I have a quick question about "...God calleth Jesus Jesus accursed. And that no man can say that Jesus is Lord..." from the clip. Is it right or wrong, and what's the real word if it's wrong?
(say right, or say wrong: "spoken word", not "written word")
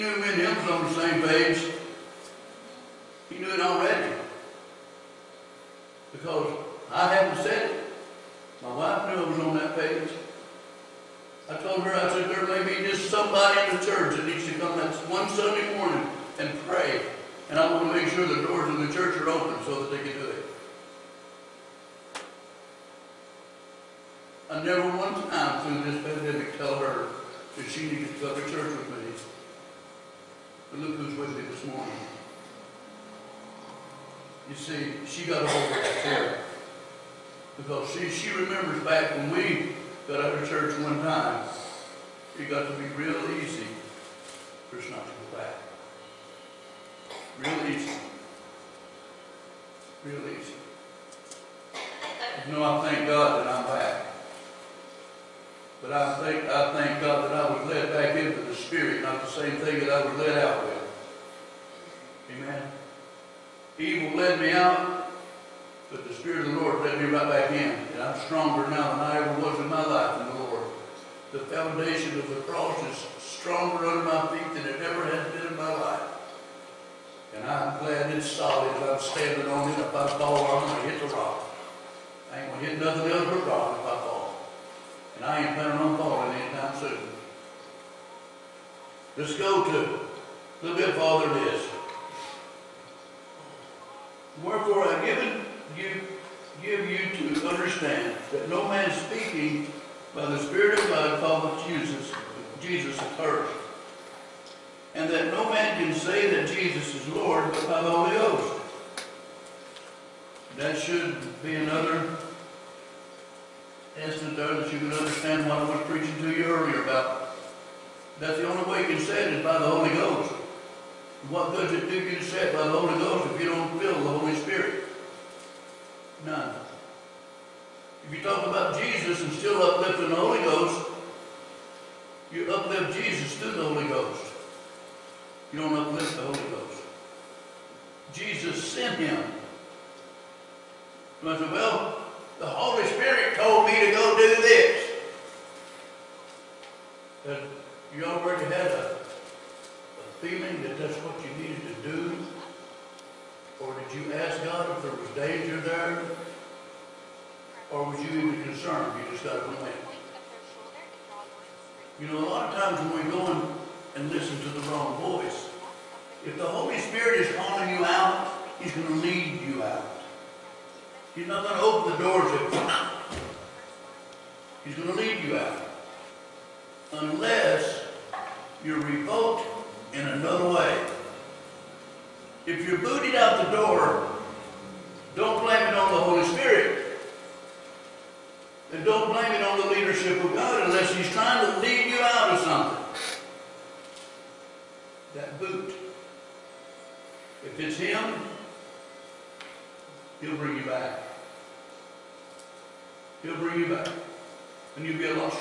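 right.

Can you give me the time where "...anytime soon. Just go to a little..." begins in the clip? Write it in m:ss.
1:26.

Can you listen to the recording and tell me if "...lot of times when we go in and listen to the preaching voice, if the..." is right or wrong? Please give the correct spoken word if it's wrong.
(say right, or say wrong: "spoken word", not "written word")
wrong: "wrong", not "preaching".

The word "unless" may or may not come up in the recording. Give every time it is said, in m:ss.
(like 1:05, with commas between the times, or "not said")
2:56, 3:10.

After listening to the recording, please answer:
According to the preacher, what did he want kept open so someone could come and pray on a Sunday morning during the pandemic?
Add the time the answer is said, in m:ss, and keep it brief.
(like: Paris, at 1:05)
The doors in the church, at 0:18.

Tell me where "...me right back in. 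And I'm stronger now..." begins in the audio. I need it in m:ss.
1:06.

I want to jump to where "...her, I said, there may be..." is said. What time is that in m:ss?
0:11.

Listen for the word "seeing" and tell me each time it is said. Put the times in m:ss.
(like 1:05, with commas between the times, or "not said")
not said.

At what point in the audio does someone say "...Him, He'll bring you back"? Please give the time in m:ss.
3:17.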